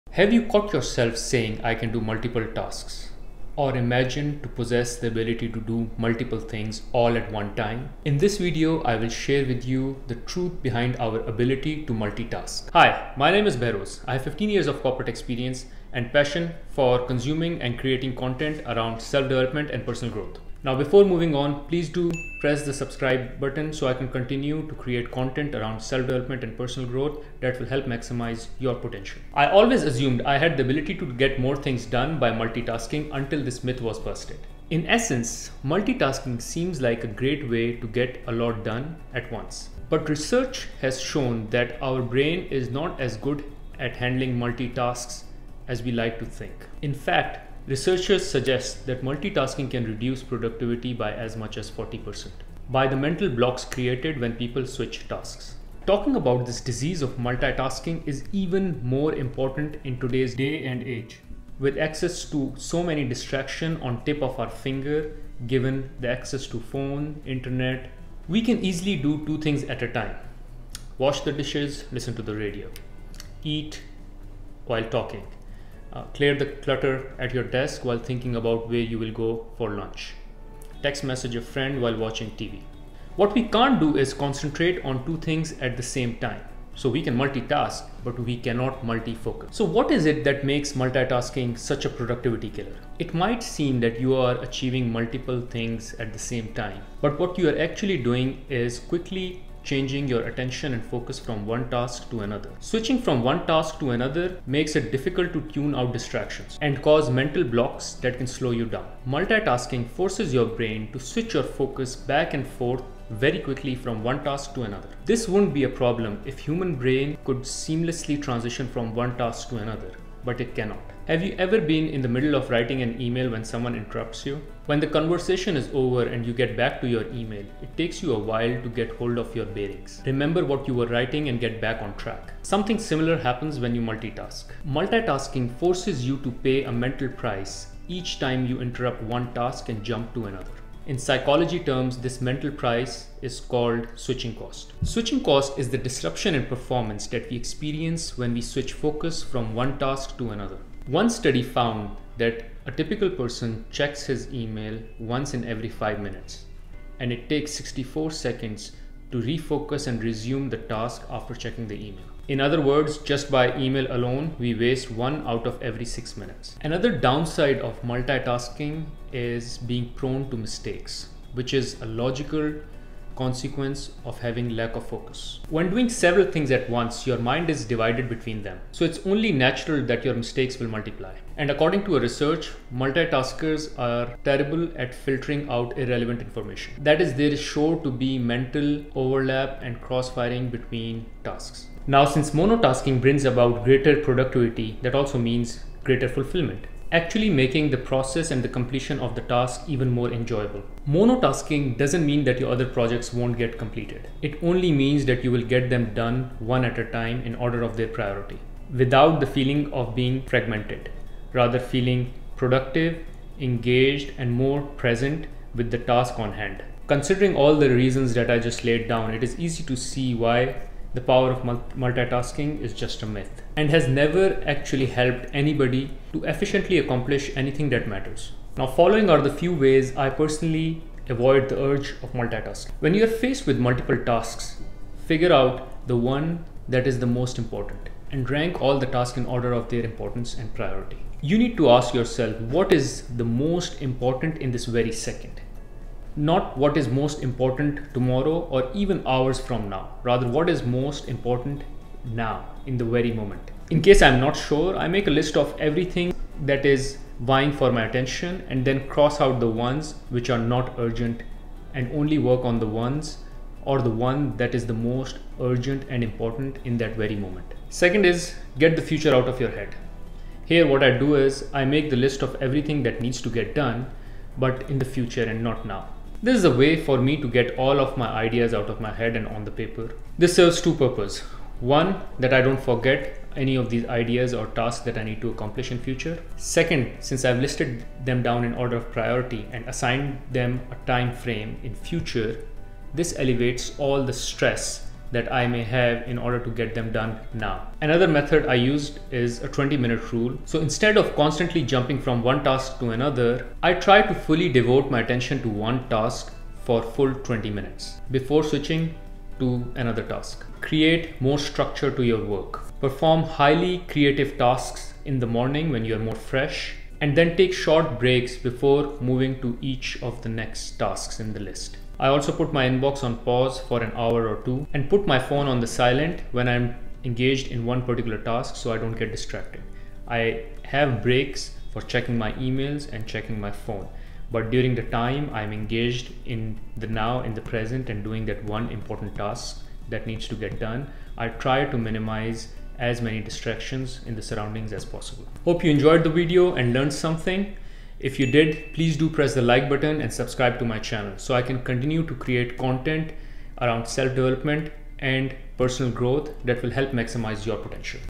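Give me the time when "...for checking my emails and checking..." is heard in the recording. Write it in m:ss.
5:31.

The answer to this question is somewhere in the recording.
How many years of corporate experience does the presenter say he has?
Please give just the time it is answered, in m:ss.
0:14.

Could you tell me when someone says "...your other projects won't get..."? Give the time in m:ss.
3:22.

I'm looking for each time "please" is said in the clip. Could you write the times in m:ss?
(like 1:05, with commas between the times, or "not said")
0:21, 5:48.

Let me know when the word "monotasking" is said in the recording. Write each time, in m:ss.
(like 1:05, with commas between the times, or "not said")
3:12, 3:20.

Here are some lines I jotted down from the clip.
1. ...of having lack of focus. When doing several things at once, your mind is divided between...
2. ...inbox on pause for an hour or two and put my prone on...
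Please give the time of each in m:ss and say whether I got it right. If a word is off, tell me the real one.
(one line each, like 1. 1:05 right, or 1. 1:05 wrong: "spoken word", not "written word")
1. 2:54 right
2. 5:22 wrong: "phone", not "prone".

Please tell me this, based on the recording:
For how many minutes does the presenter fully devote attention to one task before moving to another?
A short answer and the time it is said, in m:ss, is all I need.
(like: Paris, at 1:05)
20, at 4:59.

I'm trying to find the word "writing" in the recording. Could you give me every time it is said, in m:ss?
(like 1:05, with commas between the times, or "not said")
2:02, 2:10.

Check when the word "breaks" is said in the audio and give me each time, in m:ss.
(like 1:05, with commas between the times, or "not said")
5:17, 5:31.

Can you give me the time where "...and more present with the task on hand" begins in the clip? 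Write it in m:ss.
3:34.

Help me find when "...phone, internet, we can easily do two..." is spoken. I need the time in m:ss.
1:06.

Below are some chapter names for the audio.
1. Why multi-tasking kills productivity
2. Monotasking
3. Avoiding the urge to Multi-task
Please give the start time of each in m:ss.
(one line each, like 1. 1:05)
1. 1:22
2. 3:11
3. 3:47.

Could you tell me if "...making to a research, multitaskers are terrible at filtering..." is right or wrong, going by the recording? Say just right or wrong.
wrong.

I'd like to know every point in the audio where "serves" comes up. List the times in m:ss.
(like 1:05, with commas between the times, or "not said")
4:40.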